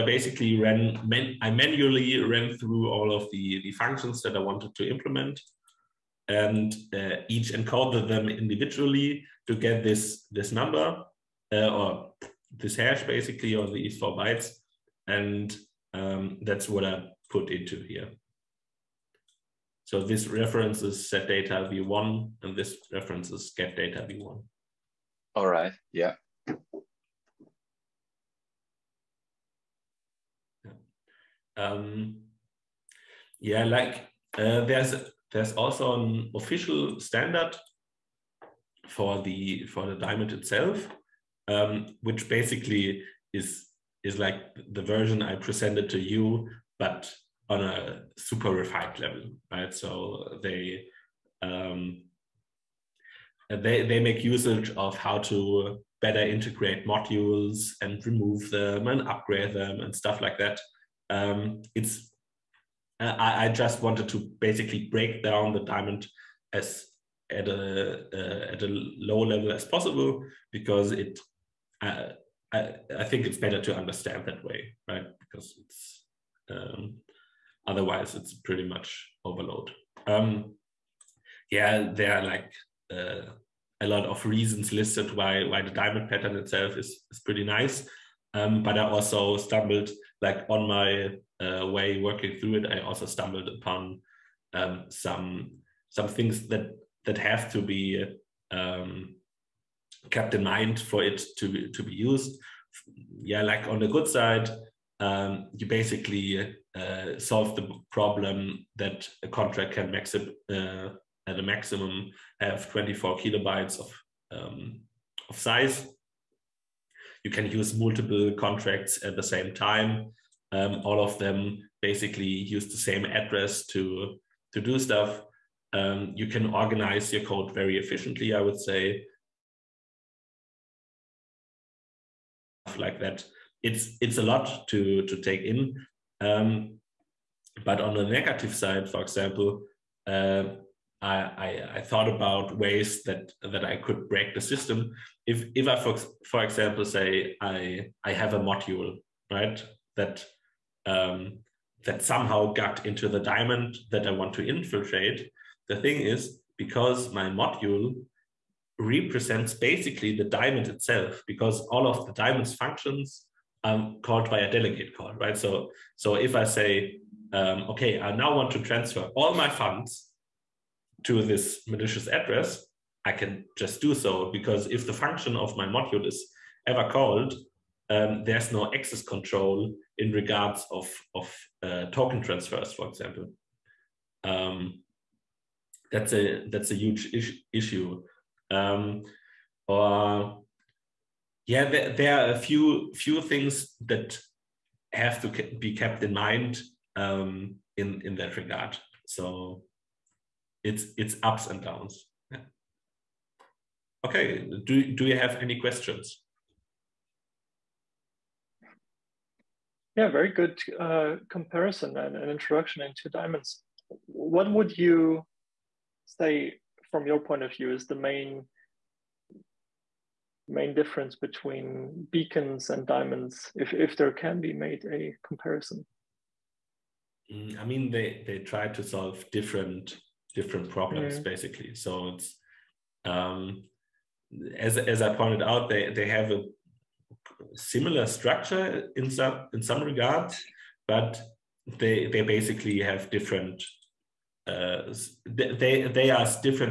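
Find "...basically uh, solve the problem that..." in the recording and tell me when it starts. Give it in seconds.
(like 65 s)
105 s.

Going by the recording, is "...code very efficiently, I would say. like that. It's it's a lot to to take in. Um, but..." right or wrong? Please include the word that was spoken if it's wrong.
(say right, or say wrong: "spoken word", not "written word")
right.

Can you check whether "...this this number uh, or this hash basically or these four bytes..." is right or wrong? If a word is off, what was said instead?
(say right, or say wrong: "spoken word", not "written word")
right.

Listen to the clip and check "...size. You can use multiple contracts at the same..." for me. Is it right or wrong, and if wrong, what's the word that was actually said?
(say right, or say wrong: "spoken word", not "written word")
right.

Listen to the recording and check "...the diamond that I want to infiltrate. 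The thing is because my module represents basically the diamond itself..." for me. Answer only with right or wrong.
right.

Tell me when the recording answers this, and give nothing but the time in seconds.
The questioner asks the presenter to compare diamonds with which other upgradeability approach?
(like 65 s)
222 s.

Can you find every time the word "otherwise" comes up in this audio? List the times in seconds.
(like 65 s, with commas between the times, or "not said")
77 s.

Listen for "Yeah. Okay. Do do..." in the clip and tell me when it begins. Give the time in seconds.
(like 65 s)
202 s.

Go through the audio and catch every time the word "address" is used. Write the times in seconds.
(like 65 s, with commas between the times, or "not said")
123 s, 172 s.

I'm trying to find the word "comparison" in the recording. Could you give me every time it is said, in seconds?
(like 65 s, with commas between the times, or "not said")
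211 s, 225 s.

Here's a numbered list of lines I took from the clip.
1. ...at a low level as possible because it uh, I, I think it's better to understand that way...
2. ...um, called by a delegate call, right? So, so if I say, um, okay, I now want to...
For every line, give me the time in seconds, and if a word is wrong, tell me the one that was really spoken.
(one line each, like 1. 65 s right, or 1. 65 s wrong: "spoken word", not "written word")
1. 68 s right
2. 163 s right.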